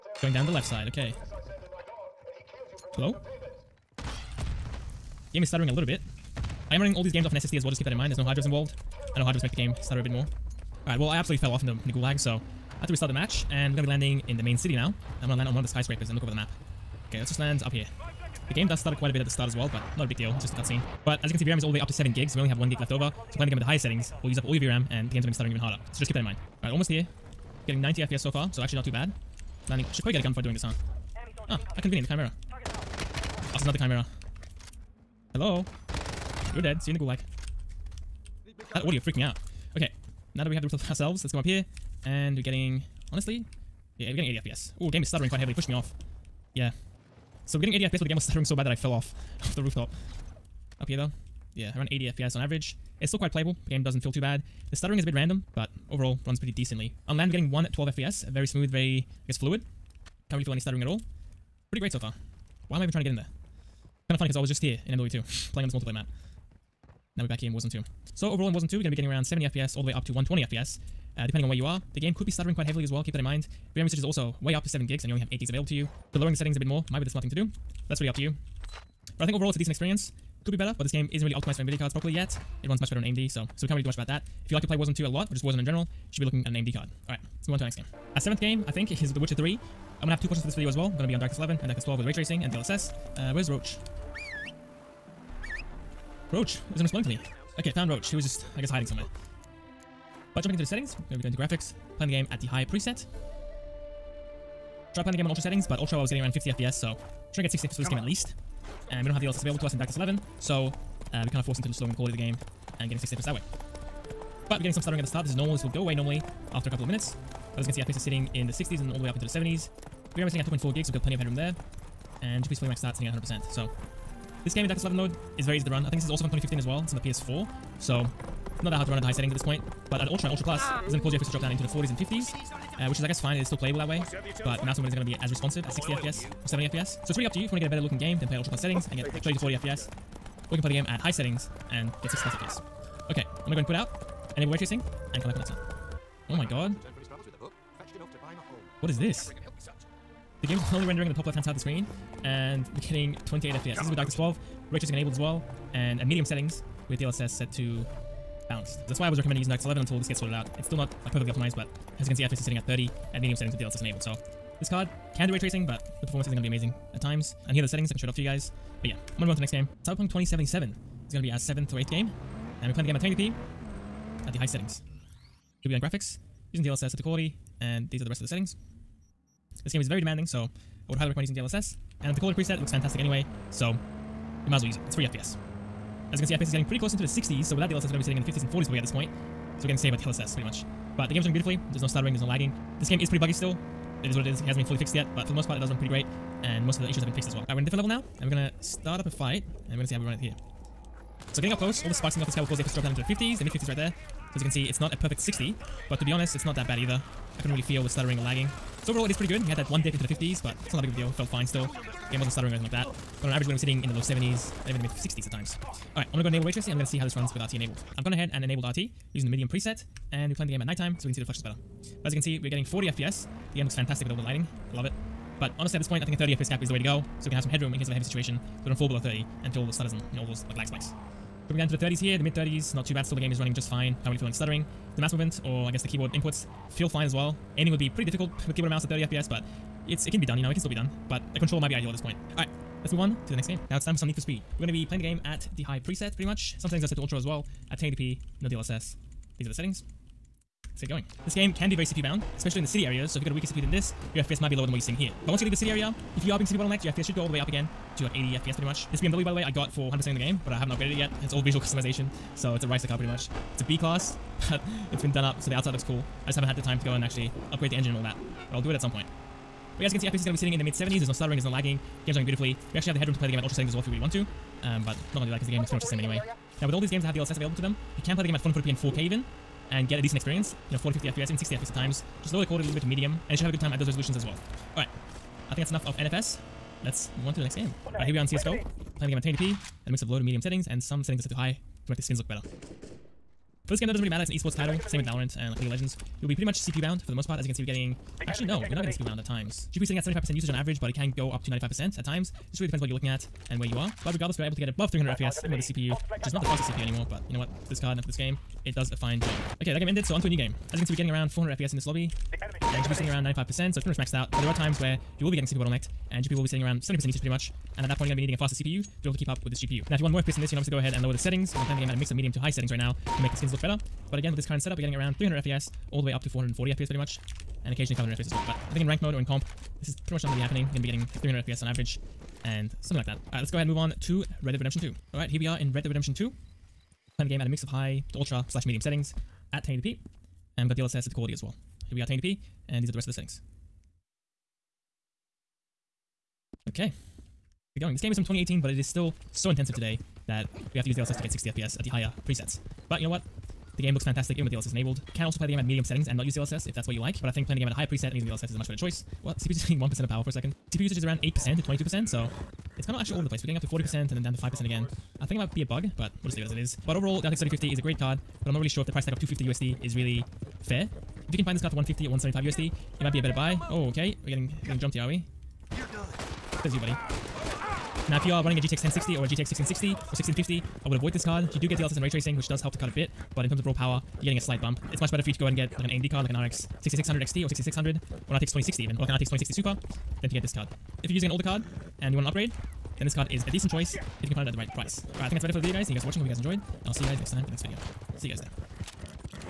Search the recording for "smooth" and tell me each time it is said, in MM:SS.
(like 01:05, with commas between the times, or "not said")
00:58.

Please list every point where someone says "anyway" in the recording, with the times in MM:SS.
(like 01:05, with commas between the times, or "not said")
03:02, 04:35.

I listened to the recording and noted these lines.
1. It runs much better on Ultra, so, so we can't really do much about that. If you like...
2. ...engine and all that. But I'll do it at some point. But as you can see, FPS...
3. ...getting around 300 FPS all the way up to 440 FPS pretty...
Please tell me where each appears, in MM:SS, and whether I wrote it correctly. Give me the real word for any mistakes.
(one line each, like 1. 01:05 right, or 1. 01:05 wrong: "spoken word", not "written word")
1. 01:22 wrong: "AMD", not "Ultra"
2. 04:27 right
3. 05:24 right.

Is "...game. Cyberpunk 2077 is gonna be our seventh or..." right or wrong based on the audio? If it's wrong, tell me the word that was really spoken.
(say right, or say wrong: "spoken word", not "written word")
right.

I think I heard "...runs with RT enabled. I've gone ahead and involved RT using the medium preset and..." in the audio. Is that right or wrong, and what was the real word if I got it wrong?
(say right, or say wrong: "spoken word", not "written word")
wrong: "enabled", not "involved".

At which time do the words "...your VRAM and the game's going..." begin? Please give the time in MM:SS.
00:24.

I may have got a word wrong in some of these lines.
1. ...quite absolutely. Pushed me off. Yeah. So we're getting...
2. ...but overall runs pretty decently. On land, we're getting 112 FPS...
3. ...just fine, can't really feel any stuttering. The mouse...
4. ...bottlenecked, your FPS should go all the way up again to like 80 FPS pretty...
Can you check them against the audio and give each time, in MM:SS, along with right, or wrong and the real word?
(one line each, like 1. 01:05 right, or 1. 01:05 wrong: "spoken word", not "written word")
1. 00:45 wrong: "heavily", not "absolutely"
2. 00:55 right
3. 03:53 right
4. 04:16 right.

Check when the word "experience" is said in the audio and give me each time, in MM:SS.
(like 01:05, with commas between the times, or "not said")
01:19, 04:40.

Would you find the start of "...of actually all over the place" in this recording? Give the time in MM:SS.
06:02.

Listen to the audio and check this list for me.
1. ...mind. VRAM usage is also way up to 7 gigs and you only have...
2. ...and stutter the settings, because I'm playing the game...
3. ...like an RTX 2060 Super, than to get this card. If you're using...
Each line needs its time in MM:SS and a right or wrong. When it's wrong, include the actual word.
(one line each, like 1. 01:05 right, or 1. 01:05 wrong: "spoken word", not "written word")
1. 01:13 right
2. 05:20 wrong: "lower", not "stutter"
3. 06:29 right.